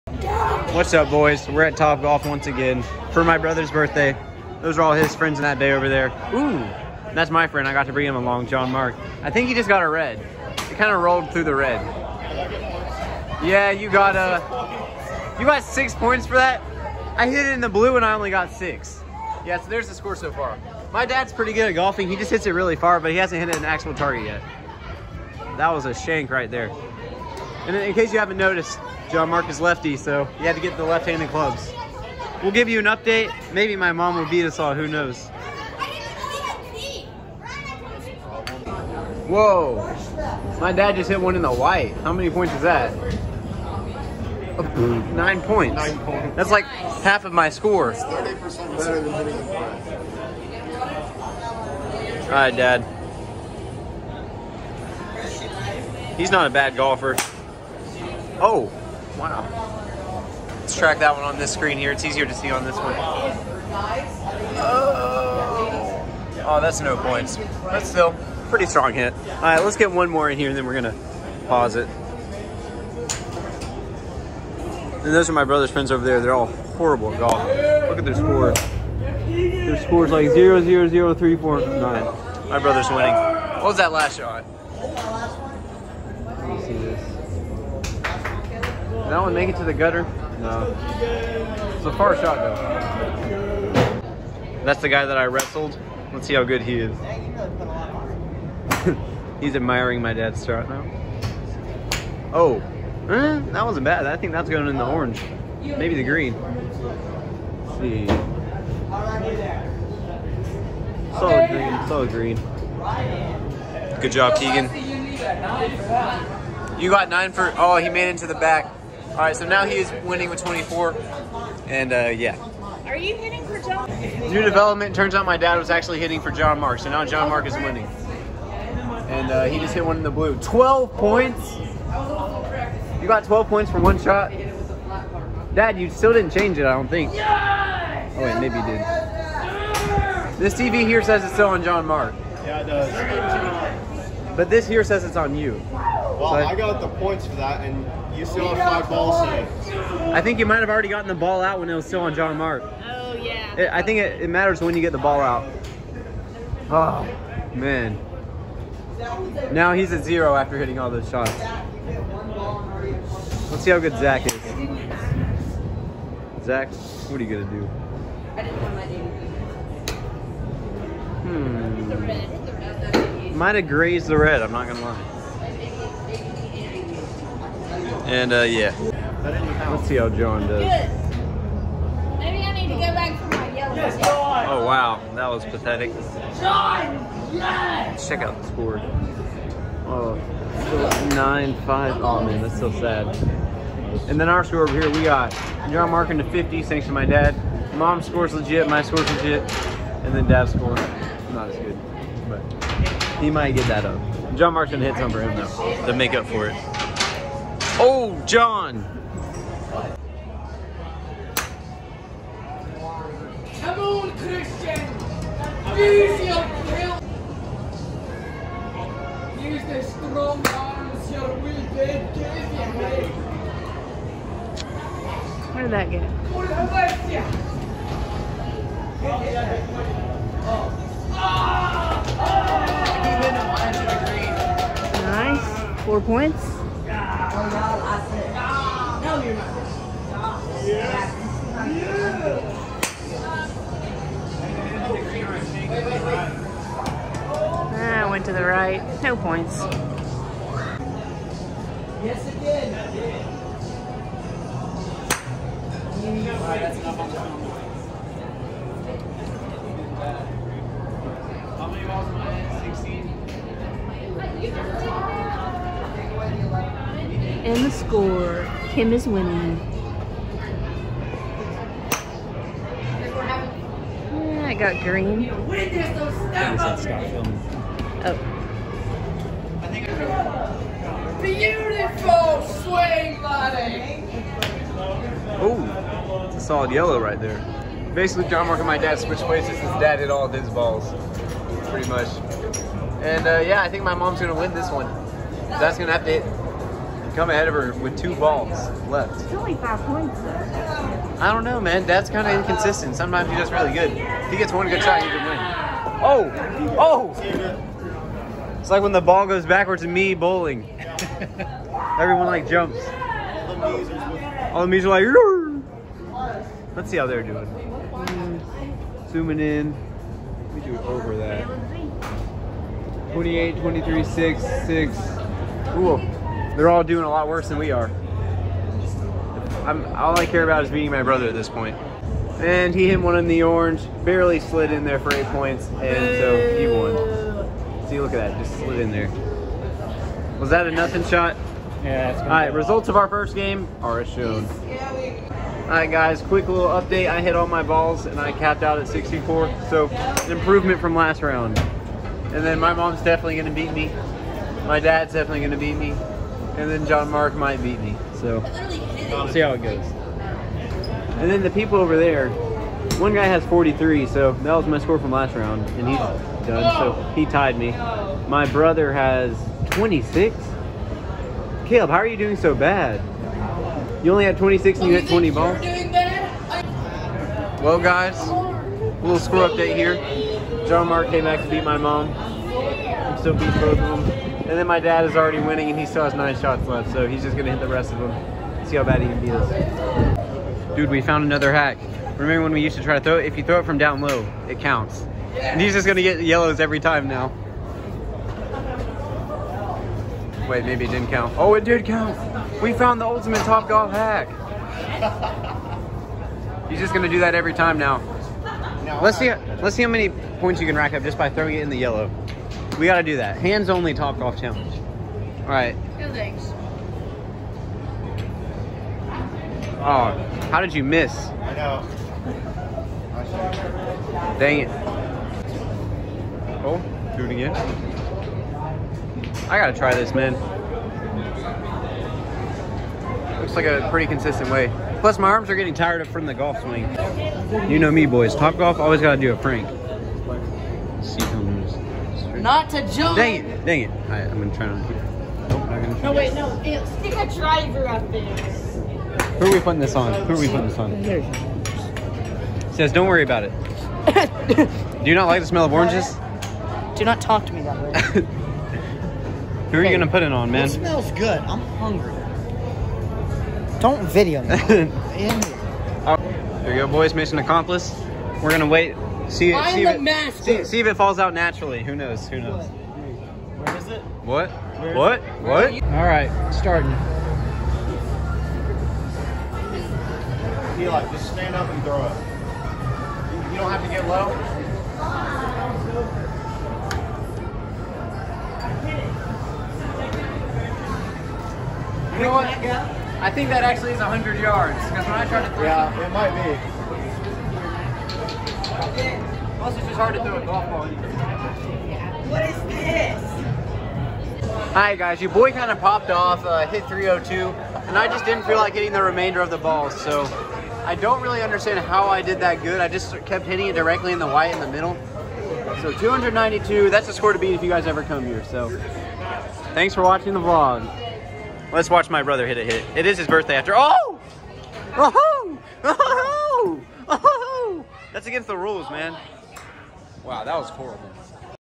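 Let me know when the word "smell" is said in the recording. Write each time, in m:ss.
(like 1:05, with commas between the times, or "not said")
7:35, 7:40.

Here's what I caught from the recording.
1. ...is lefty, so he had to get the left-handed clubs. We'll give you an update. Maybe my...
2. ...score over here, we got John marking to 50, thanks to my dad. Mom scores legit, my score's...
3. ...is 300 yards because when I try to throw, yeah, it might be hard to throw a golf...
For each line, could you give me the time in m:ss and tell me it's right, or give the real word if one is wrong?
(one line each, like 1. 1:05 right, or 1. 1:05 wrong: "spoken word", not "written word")
1. 0:29 right
2. 3:14 right
3. 8:13 wrong: "100", not "300".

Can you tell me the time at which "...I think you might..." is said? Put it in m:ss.
2:30.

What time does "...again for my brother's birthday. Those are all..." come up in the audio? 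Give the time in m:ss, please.
0:02.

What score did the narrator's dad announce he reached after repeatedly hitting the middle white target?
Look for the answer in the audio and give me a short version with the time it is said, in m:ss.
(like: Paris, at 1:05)
302, at 8:26.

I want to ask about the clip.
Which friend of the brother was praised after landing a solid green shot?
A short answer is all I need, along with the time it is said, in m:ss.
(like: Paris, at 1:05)
Keegan, at 1:54.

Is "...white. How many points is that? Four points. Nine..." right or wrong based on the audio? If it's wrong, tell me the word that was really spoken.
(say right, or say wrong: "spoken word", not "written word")
wrong: "Nine", not "Four".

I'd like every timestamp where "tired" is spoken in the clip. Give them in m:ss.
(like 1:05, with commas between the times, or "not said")
7:15.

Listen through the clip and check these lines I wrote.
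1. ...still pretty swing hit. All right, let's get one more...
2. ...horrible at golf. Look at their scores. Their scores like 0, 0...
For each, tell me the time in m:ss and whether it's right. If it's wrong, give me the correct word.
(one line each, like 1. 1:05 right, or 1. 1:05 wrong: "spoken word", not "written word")
1. 1:07 wrong: "strong", not "swing"
2. 1:16 right.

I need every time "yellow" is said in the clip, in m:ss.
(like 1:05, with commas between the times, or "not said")
3:03, 4:46, 6:36, 6:51.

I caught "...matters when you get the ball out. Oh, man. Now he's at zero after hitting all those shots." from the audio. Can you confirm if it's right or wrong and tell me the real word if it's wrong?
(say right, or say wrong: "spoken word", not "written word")
right.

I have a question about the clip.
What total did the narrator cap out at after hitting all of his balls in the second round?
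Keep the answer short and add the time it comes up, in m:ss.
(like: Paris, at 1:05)
64, at 5:48.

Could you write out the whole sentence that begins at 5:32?
And he hit one in the orange, barely slid in there for eight points, and so he won.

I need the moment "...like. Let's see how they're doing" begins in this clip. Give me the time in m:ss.
5:15.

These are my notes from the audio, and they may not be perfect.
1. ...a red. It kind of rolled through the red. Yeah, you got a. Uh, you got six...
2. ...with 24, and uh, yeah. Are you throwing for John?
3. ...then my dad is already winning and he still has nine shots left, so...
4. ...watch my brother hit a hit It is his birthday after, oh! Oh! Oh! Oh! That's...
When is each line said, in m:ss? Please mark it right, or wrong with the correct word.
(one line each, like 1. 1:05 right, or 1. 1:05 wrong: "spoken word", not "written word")
1. 0:09 right
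2. 2:00 wrong: "hitting", not "throwing"
3. 6:24 right
4. 8:41 right.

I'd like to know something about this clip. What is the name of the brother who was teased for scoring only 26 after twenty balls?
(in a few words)
Caleb.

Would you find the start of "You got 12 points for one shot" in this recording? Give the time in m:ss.
2:13.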